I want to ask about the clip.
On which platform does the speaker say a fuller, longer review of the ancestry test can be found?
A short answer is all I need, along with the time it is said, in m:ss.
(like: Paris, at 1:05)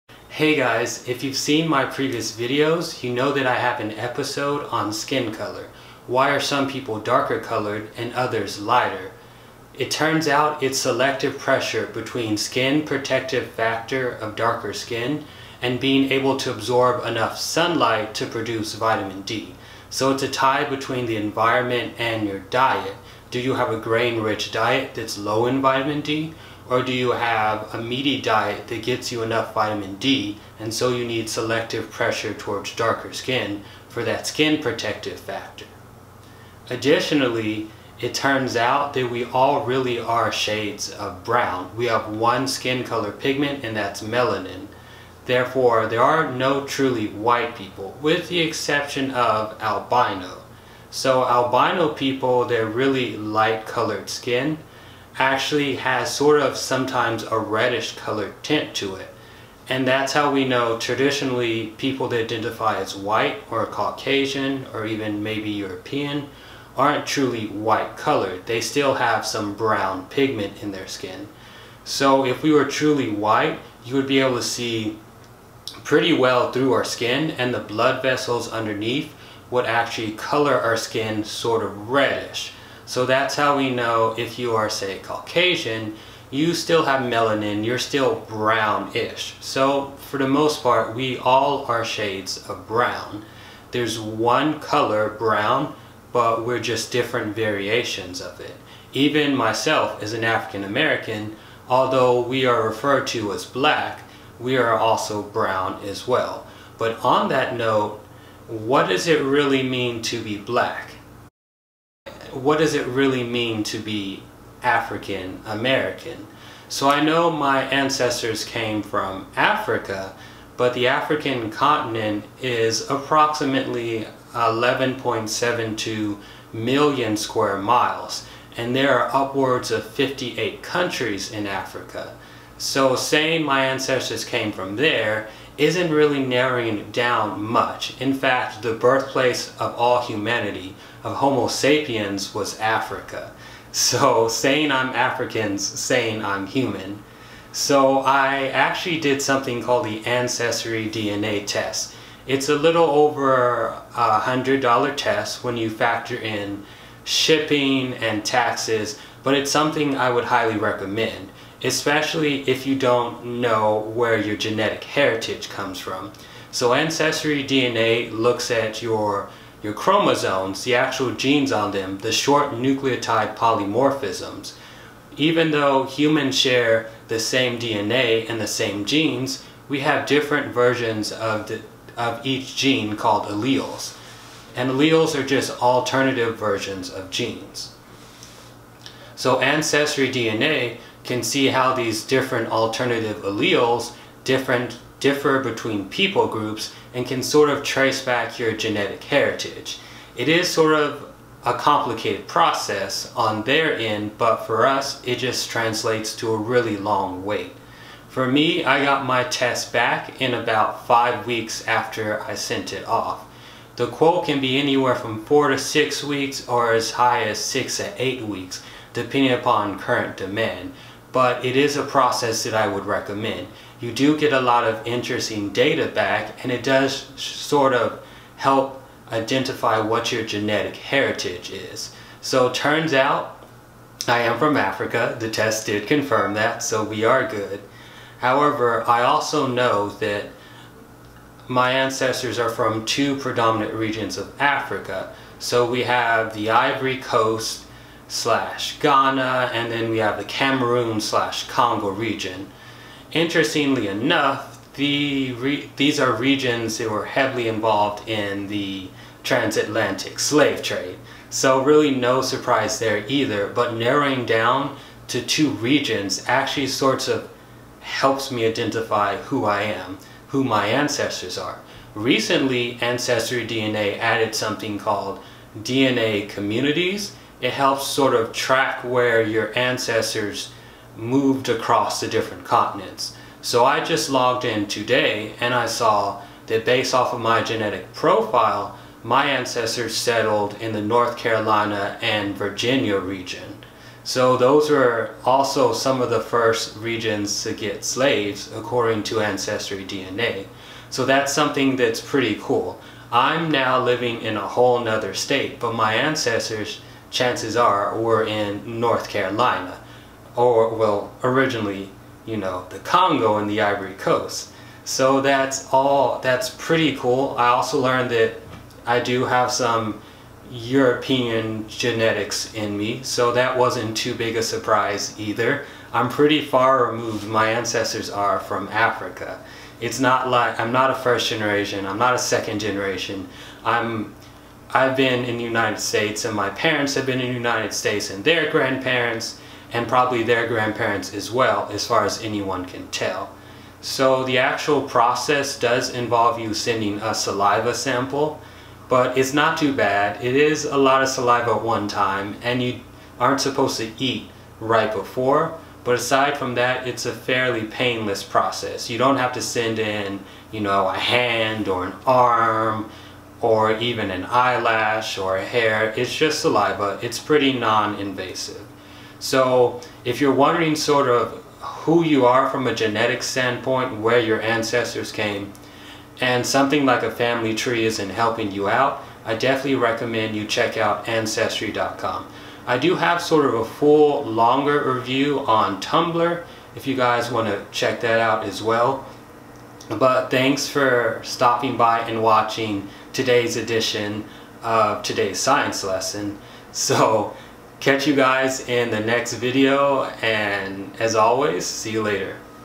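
Tumblr, at 6:25.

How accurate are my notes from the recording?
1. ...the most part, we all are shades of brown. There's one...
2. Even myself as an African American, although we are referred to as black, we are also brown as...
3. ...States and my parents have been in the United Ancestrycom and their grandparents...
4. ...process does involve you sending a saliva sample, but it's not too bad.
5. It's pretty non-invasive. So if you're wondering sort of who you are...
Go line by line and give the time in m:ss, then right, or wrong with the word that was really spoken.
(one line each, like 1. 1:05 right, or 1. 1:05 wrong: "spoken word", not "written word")
1. 1:30 right
2. 1:38 right
3. 5:35 wrong: "States", not "Ancestrycom"
4. 5:44 right
5. 6:07 right.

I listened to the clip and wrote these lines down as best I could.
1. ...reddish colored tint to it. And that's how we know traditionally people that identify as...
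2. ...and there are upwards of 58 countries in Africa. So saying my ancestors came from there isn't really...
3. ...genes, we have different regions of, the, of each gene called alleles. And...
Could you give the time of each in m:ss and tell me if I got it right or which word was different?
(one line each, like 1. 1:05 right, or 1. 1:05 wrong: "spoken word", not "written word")
1. 0:57 right
2. 2:08 right
3. 2:58 wrong: "versions", not "regions".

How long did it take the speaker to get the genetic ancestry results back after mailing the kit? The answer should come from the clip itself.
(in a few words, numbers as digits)
About 5 weeks.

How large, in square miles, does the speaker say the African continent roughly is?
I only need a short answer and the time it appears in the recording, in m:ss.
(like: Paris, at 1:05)
11.72 million square miles, at 2:04.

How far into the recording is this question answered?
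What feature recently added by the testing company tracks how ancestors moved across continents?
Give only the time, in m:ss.
4:35.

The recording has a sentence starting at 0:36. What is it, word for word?
Additionally, it turns out that we all really are shades of brown.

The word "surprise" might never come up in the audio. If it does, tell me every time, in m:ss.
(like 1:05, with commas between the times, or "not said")
4:22, 5:24.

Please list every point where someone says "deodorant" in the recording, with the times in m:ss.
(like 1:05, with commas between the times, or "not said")
not said.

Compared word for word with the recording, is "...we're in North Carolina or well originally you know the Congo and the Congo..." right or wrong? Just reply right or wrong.
wrong.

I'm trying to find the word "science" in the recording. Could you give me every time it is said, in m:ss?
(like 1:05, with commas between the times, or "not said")
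6:35.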